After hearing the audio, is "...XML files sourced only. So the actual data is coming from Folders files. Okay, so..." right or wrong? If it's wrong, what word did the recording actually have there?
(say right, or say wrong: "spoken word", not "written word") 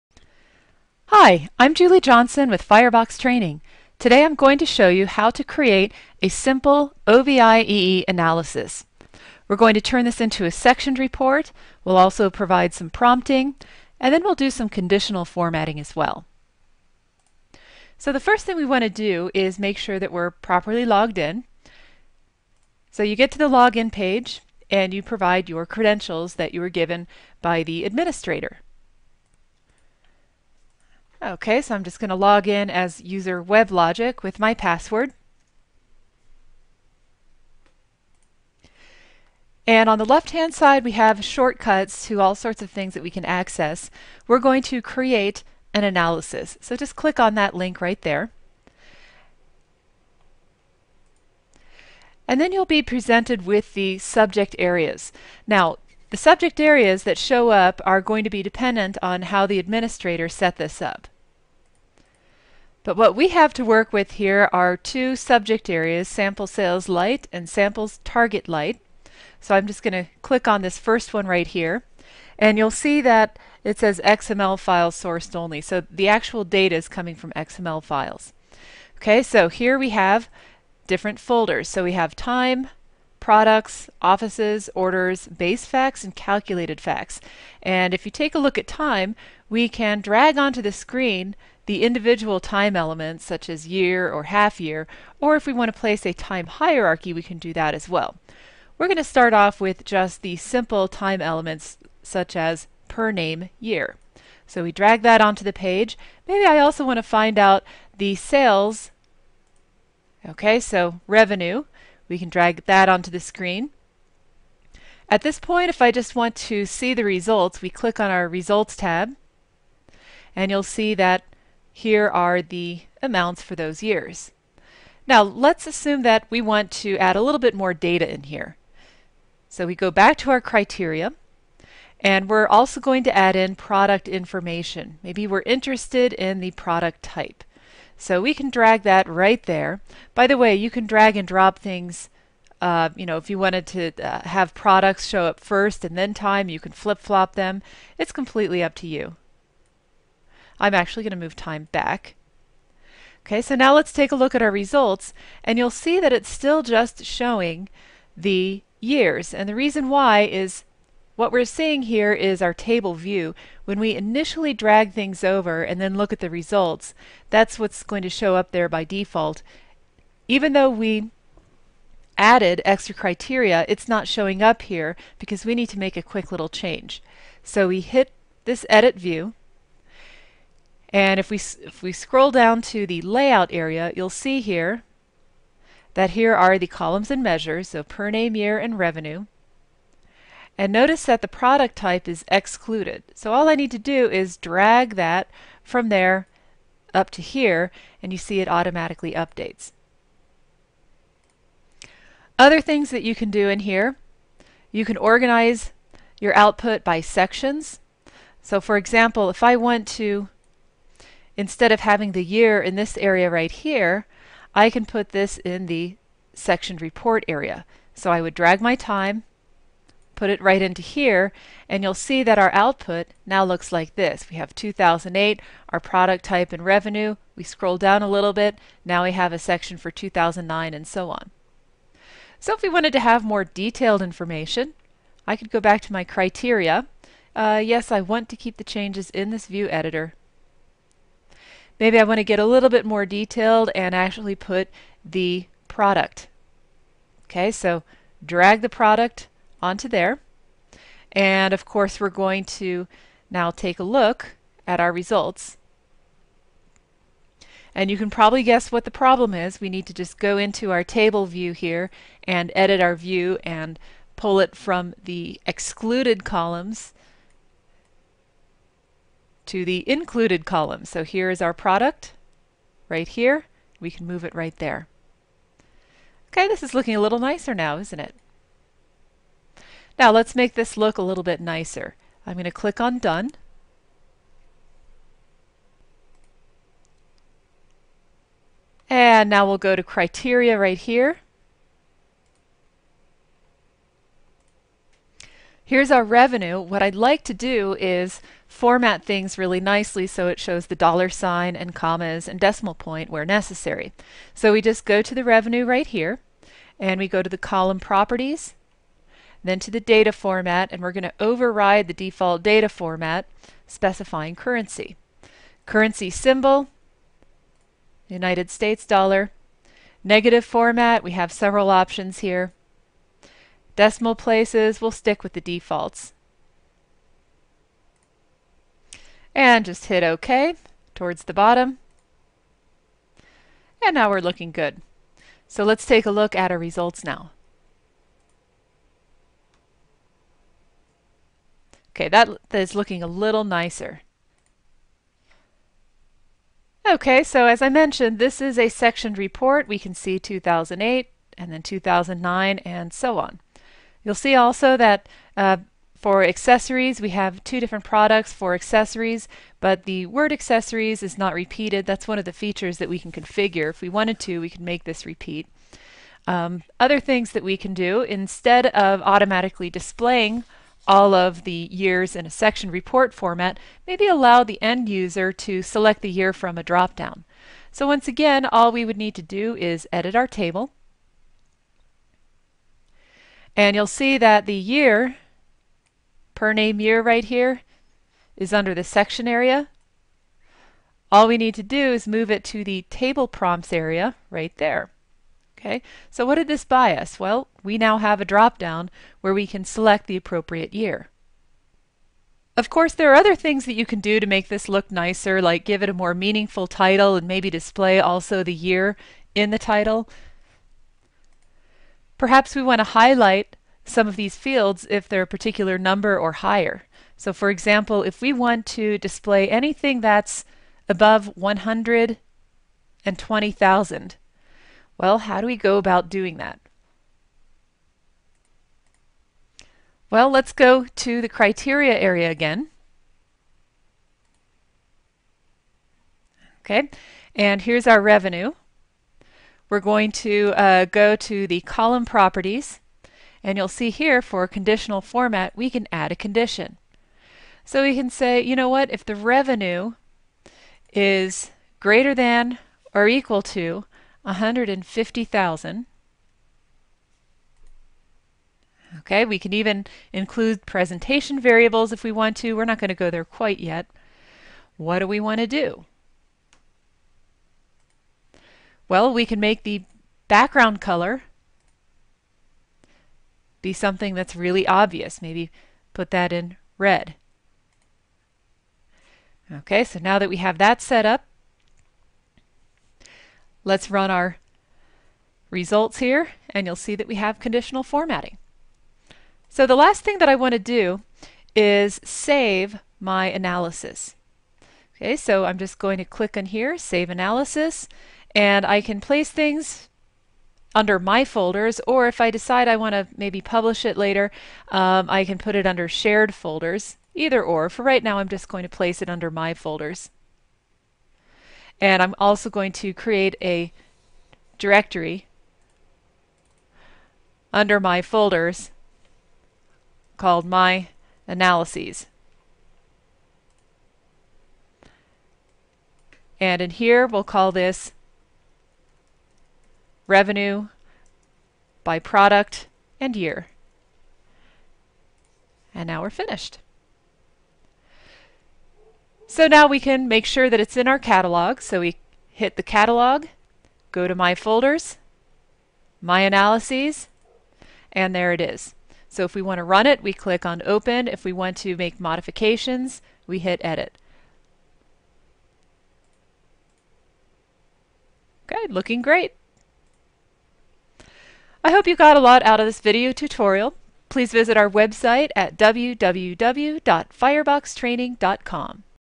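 wrong: "XML", not "Folders".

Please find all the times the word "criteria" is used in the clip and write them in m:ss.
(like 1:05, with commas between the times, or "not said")
2:10, 2:52, 3:56, 4:49, 7:11.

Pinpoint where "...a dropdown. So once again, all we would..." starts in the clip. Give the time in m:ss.
6:16.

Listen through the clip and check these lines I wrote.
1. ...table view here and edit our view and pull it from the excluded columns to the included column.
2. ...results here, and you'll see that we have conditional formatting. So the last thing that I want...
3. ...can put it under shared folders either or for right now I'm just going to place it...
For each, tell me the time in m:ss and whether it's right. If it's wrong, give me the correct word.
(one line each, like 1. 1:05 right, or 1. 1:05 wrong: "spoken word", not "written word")
1. 4:20 right
2. 8:05 right
3. 8:25 right.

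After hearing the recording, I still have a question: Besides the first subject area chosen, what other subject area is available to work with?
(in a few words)
Samples target light.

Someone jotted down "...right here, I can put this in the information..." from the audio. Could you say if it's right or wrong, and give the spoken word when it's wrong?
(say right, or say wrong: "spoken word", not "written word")
wrong: "section", not "information".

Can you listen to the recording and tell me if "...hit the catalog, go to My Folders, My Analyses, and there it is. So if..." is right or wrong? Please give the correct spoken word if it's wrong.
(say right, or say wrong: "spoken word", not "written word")
right.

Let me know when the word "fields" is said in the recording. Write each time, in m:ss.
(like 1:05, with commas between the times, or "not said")
6:54.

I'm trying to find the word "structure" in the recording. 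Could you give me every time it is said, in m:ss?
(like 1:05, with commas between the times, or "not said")
not said.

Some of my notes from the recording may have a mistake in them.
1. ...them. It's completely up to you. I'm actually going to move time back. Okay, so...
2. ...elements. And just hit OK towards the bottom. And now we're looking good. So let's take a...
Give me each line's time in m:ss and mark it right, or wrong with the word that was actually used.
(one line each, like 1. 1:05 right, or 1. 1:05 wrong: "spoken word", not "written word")
1. 2:27 right
2. 5:25 wrong: "defaults", not "elements".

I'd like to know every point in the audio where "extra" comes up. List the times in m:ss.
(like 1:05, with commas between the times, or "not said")
2:52.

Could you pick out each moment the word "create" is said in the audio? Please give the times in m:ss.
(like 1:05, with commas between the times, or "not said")
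0:05, 0:44, 8:32.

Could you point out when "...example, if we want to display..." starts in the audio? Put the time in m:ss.
6:57.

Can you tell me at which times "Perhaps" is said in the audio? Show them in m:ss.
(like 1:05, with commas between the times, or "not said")
6:52.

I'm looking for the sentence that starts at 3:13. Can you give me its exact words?
So all I need to do is drag that from there up to here, and you see it automatically updates.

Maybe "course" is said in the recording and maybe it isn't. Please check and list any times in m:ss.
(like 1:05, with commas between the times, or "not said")
4:11, 6:42.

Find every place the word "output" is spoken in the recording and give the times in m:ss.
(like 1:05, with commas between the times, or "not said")
3:26, 3:42.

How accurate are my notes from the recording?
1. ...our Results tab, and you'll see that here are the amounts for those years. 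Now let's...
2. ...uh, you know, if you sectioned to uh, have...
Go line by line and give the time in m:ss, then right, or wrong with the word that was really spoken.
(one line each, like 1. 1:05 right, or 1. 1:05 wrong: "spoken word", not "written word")
1. 1:58 right
2. 2:22 wrong: "wanted", not "sectioned".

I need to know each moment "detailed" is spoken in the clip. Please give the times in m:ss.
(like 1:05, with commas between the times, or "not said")
3:53, 4:03.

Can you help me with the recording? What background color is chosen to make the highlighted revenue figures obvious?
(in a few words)
Red.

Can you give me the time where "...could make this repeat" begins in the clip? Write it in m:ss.
6:04.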